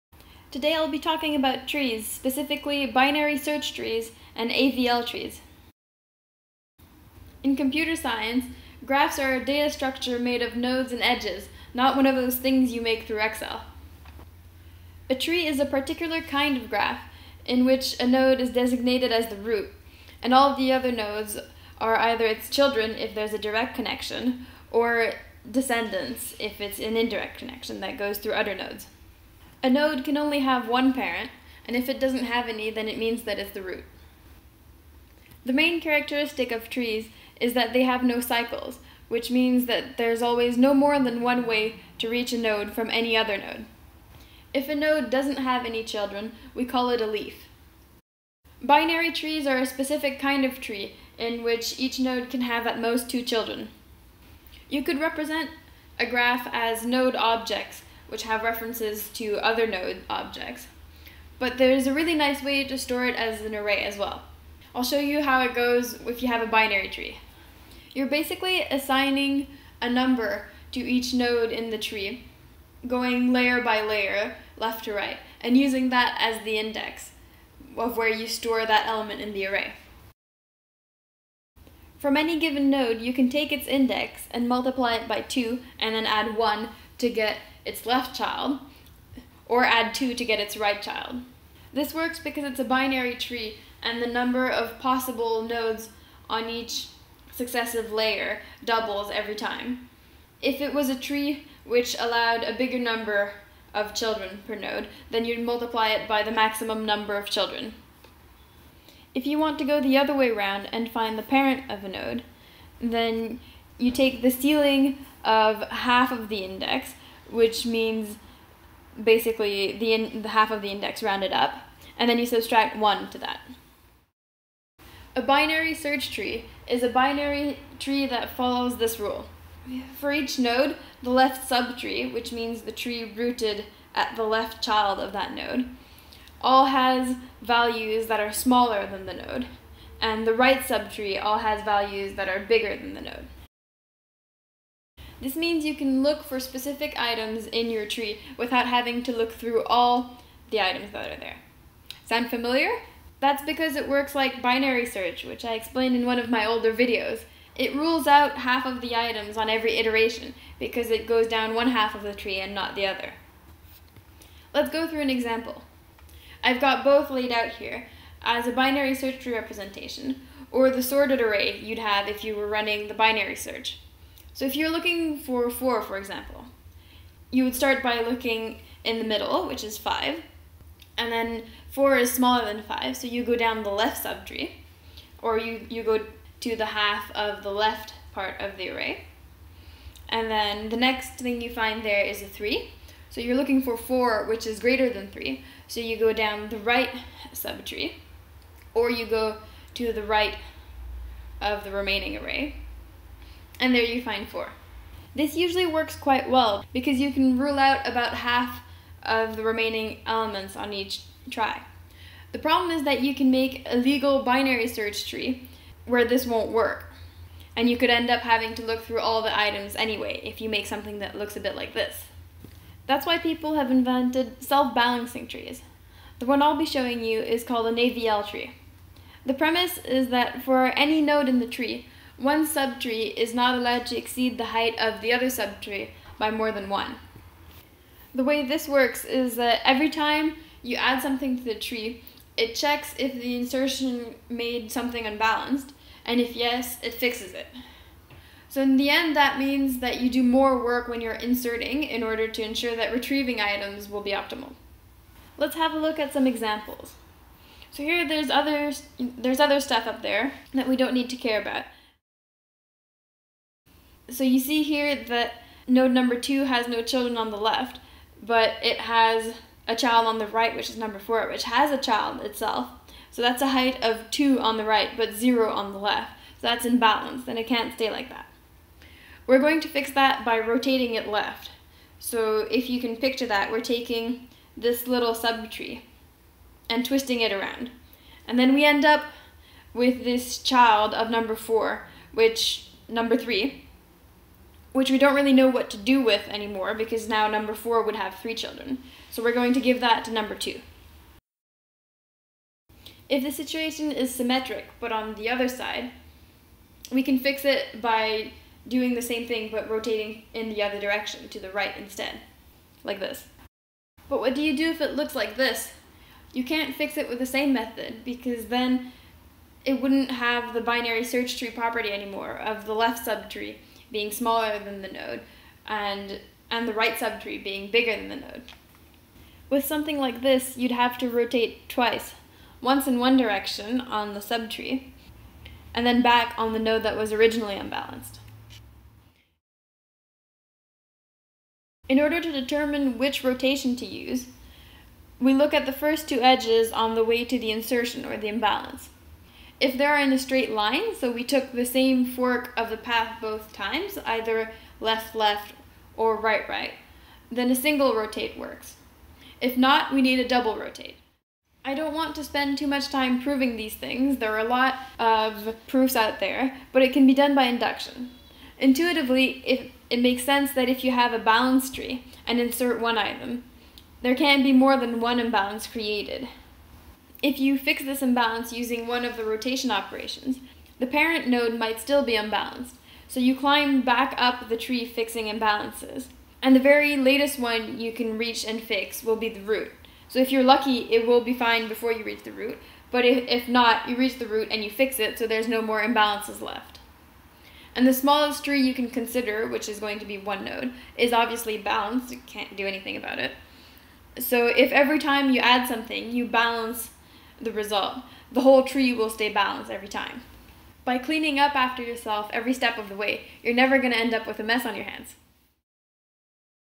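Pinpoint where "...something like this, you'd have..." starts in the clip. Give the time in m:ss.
5:29.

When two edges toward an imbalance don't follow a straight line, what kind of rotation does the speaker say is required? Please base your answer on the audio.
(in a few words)
double rotate.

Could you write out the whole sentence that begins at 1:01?
But there's a really nice way to store it as an array as well.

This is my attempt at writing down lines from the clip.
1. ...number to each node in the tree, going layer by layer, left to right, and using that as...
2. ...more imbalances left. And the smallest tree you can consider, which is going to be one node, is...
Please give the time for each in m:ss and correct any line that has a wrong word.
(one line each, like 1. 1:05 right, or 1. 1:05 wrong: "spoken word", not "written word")
1. 1:09 right
2. 6:35 right.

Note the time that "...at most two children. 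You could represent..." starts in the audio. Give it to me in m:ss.
0:52.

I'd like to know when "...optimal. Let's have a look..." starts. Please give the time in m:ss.
4:14.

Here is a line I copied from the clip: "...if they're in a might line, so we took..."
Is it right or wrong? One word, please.
wrong.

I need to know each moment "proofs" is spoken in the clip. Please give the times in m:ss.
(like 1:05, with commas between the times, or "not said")
6:05.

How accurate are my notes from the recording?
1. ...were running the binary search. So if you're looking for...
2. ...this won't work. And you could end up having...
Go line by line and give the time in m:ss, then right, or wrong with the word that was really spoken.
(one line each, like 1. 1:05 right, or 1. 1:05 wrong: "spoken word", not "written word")
1. 2:52 right
2. 3:36 right.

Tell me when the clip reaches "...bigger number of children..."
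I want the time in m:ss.
1:42.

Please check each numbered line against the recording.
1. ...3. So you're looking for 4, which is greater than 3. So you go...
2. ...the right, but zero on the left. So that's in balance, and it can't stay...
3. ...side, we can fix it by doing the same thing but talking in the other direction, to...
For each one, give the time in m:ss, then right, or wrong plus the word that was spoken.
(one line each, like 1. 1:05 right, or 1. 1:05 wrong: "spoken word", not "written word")
1. 3:12 right
2. 4:34 right
3. 5:05 wrong: "rotating", not "talking".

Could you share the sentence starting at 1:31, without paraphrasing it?
This works because it's a binary tree and the number of possible nodes on each successive layer doubles every time.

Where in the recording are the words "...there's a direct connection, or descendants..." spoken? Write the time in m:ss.
0:23.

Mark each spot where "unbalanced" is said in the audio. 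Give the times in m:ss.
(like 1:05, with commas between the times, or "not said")
4:05, 5:37, 6:22.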